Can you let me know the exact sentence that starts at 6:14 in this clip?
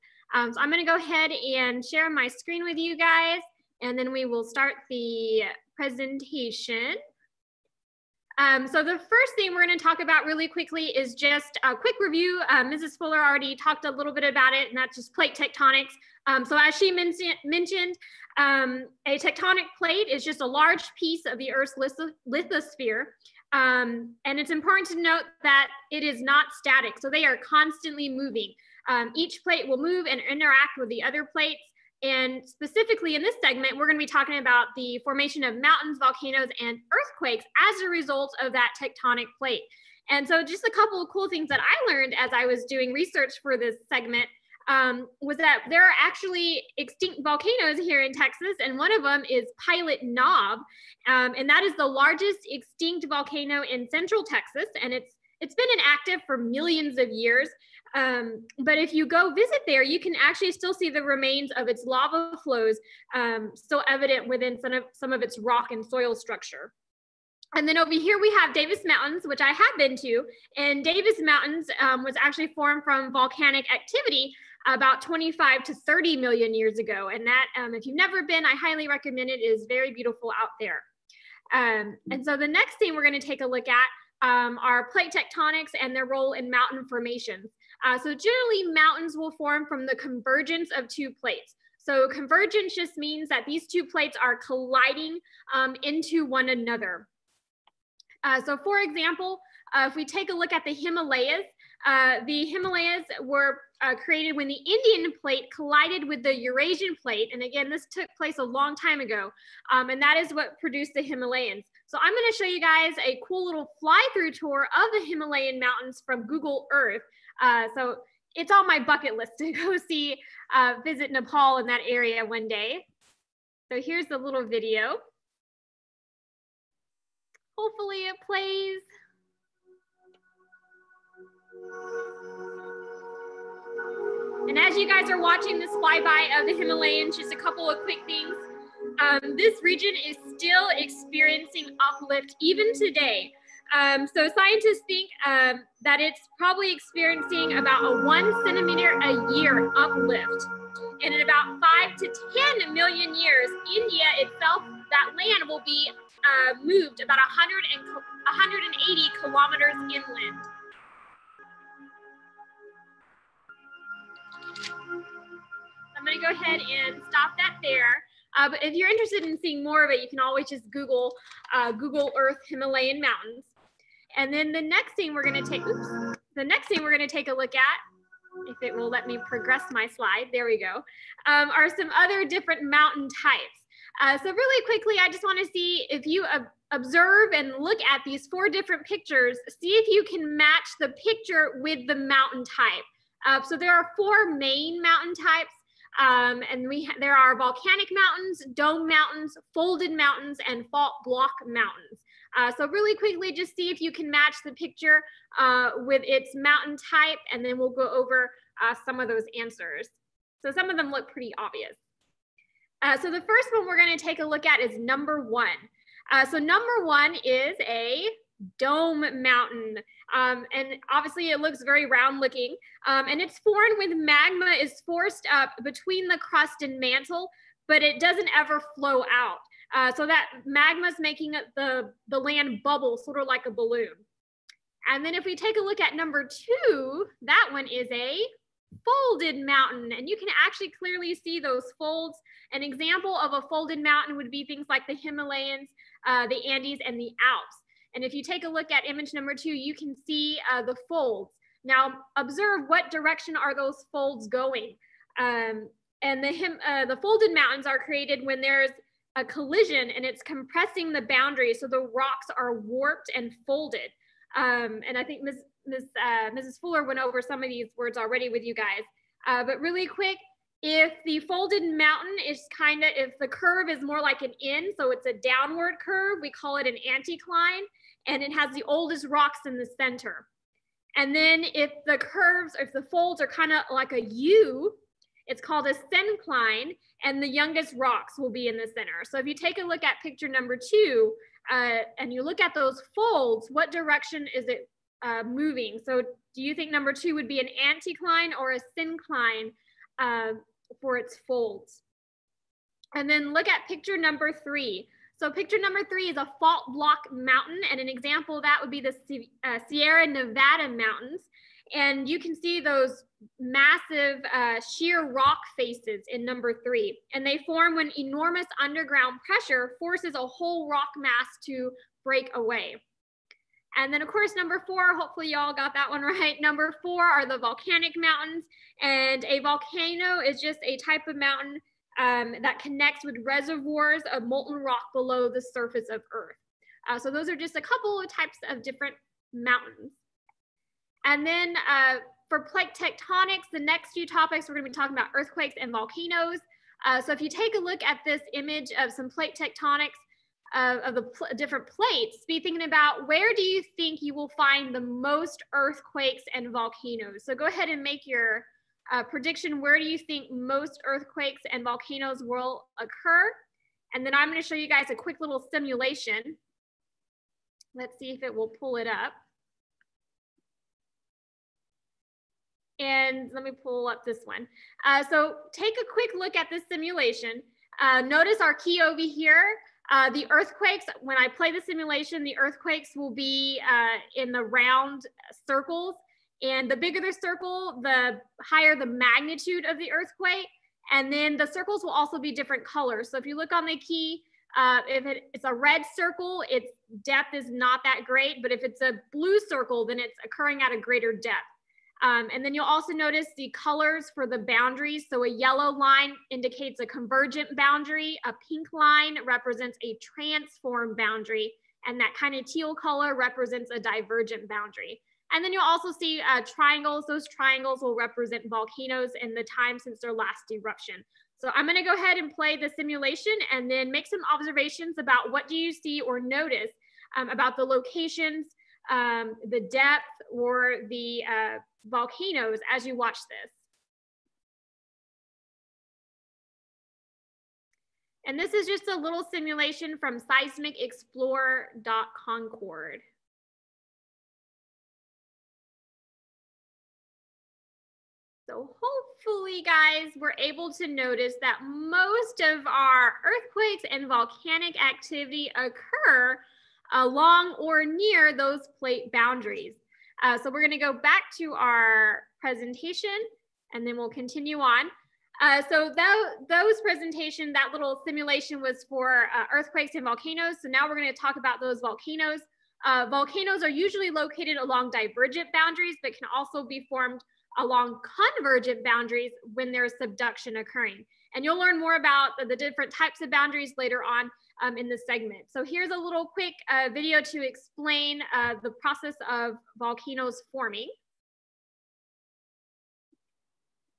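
Uh, so take a quick look at this simulation.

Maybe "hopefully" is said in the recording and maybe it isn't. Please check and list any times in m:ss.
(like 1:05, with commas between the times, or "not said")
2:07, 5:24, 7:28.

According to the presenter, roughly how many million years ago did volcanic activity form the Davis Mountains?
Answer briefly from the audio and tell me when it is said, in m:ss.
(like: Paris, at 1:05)
25 to 30 million, at 1:15.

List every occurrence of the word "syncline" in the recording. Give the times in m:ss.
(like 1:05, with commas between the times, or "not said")
4:45, 4:58.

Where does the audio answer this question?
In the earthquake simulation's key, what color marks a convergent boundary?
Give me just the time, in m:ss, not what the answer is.
6:45.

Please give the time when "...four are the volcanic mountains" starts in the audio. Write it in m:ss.
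5:26.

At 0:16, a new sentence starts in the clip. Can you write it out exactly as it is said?
Um, so as she men mentioned, um, a tectonic plate is just a large piece of the Earth's lithosphere.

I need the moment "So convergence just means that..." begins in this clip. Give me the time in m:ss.
1:31.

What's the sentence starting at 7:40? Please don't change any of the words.
Uh, so we're gonna go back to our presentation and then we'll continue on.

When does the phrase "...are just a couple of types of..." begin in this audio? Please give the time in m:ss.
5:37.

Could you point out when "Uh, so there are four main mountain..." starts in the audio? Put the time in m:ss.
3:13.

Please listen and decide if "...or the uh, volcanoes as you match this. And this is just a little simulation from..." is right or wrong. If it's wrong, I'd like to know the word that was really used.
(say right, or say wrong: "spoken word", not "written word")
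wrong: "watch", not "match".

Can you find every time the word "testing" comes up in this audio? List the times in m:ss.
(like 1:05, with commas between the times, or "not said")
not said.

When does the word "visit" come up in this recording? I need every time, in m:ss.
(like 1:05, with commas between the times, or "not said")
0:59, 2:00.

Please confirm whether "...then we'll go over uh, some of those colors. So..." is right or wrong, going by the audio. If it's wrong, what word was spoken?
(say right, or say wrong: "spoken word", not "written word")
wrong: "answers", not "colors".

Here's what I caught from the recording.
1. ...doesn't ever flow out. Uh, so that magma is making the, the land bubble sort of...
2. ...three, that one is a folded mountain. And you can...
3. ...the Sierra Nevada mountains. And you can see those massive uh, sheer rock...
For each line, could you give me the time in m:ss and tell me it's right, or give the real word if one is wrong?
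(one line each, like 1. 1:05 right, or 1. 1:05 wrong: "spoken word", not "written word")
1. 3:47 right
2. 3:56 wrong: "two", not "three"
3. 5:08 right.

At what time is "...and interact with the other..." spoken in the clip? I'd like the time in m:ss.
0:30.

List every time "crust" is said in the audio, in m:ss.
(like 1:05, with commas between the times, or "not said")
3:46.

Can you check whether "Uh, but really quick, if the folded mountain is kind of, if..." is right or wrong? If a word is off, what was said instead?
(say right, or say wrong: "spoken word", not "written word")
right.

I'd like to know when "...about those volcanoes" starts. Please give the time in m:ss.
7:51.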